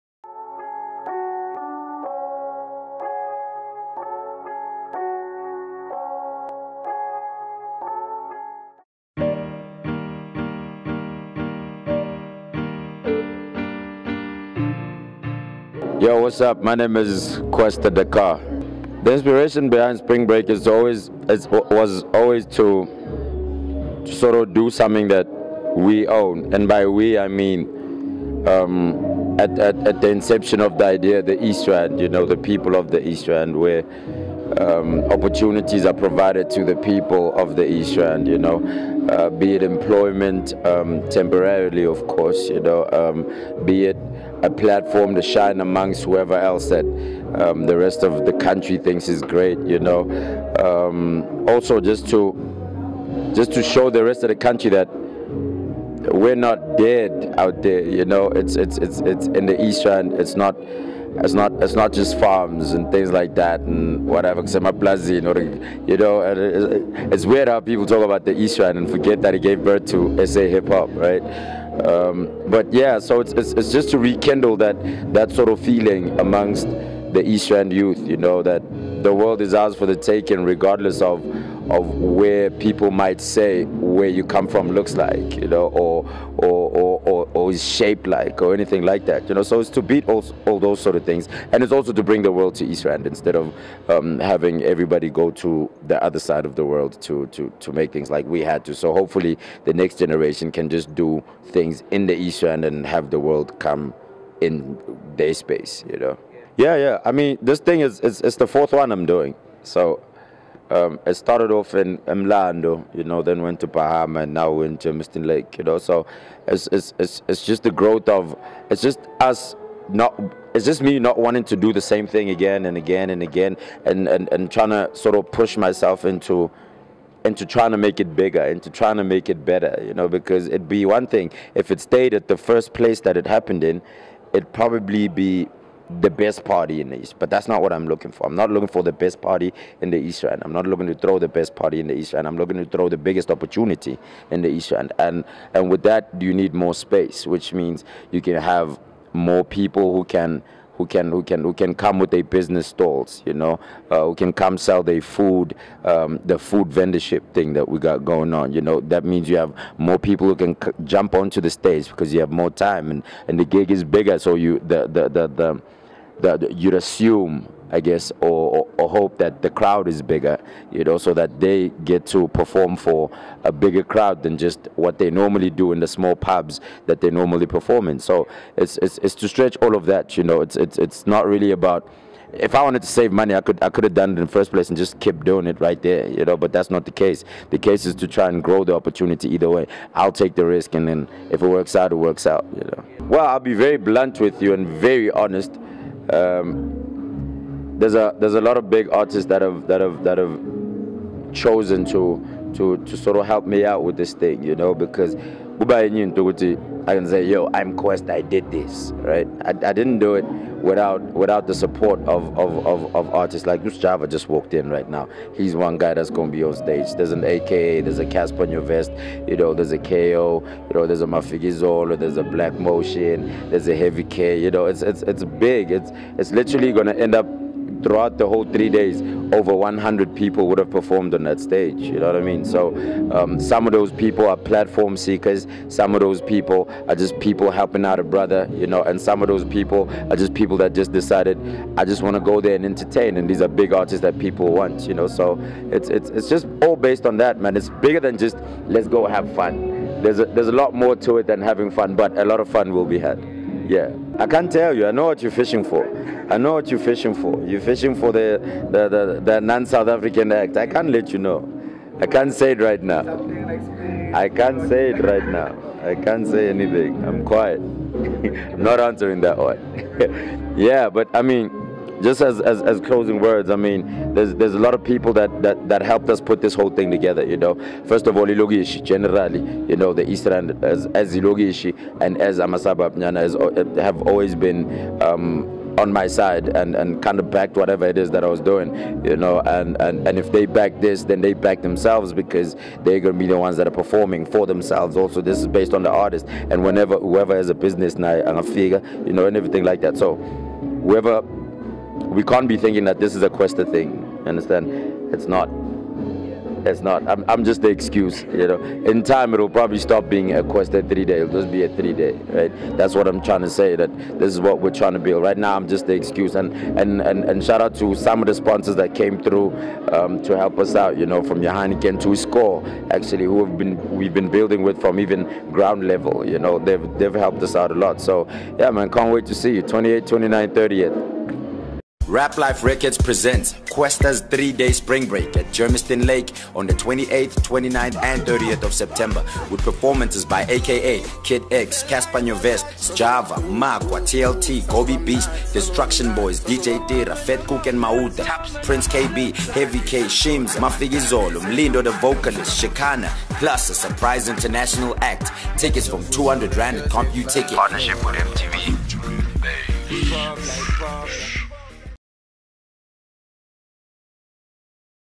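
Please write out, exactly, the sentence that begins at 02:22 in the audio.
I'm looking to throw the biggest opportunity in the East Rand.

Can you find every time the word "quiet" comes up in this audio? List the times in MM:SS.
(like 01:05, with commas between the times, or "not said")
04:27.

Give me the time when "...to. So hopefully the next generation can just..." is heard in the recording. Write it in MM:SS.
01:38.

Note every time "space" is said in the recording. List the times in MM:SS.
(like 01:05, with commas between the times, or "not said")
01:45, 02:26.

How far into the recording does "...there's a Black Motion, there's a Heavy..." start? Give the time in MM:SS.
03:41.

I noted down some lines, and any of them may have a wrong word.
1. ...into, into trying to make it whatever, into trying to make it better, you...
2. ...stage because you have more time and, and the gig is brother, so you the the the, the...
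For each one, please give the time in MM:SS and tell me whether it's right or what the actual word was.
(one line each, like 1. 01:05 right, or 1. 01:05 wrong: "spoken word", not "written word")
1. 02:06 wrong: "bigger", not "whatever"
2. 02:41 wrong: "bigger", not "brother".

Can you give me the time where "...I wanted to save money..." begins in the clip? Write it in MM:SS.
03:02.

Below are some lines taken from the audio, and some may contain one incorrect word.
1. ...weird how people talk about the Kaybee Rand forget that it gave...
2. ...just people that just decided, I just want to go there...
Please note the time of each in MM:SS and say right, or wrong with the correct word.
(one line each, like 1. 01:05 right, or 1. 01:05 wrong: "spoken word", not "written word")
1. 01:07 wrong: "East", not "Kaybee"
2. 04:00 right.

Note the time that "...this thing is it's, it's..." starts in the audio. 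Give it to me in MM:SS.
01:47.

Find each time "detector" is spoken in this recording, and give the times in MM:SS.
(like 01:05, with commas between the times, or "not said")
not said.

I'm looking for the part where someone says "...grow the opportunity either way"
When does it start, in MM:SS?
03:08.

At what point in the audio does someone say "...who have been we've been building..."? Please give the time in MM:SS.
05:23.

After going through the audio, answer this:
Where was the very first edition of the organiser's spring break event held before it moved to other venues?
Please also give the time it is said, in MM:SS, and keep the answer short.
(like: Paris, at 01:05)
Mlando, at 01:52.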